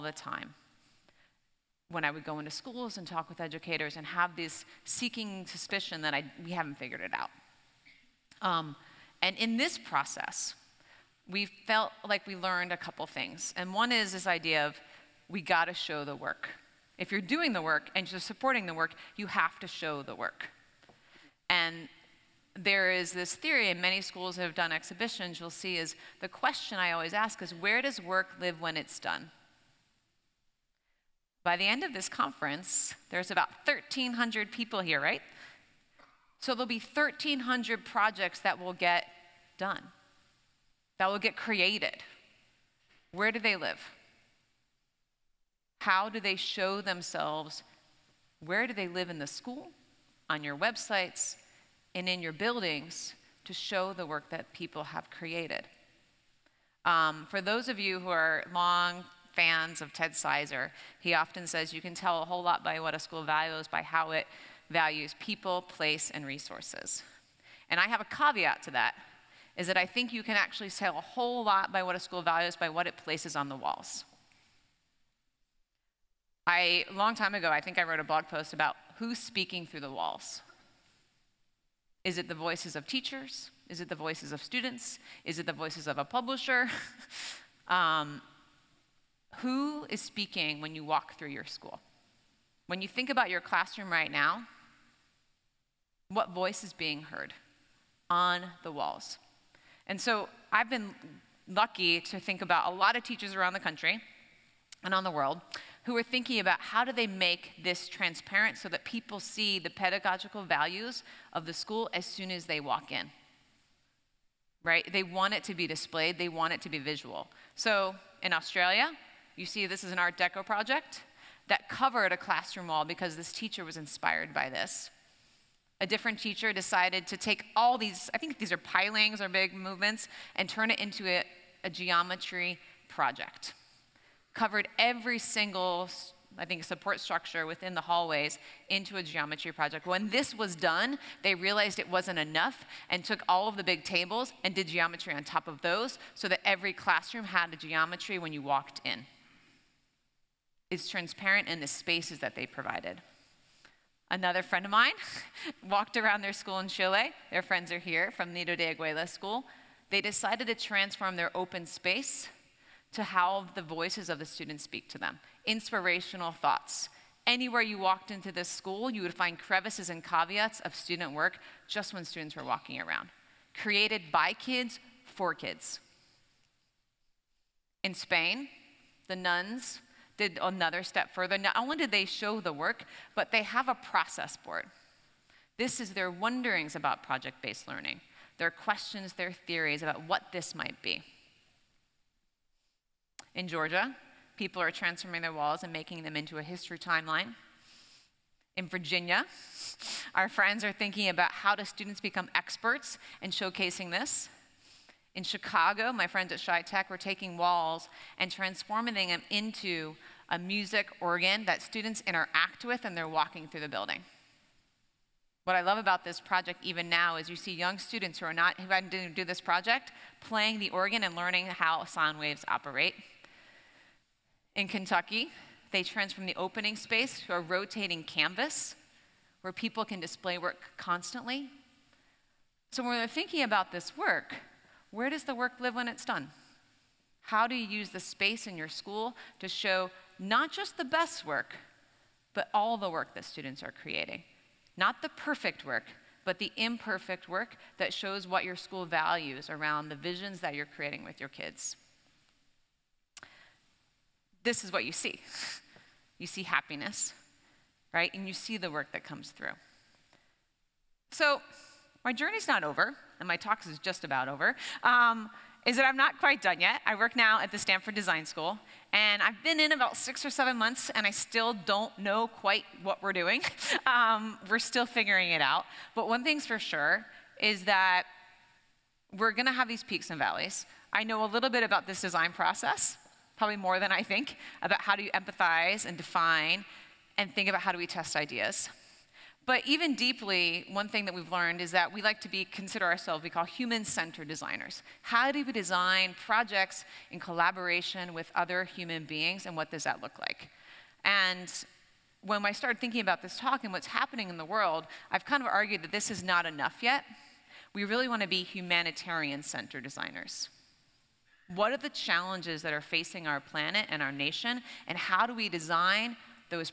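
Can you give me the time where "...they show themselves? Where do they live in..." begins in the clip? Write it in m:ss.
0:46.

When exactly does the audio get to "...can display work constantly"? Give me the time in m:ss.
3:49.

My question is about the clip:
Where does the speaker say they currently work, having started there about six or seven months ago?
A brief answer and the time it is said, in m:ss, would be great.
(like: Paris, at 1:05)
Stanford Design School, at 4:27.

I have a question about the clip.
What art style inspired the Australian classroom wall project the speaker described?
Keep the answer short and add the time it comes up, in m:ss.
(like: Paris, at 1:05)
Art Deco, at 1:59.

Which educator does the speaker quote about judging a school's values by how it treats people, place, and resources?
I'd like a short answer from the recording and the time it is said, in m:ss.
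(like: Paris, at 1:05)
Ted Sizer, at 0:59.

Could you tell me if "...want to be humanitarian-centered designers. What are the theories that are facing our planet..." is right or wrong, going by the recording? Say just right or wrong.
wrong.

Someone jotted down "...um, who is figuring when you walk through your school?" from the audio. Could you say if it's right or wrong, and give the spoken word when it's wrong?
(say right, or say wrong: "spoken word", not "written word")
wrong: "speaking", not "figuring".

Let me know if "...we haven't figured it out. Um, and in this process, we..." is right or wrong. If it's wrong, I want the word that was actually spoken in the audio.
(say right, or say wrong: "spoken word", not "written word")
right.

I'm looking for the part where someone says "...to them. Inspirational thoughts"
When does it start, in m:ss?
2:44.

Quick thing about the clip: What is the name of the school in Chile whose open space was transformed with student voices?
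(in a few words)
Nido de Águilas School.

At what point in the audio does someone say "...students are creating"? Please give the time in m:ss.
4:03.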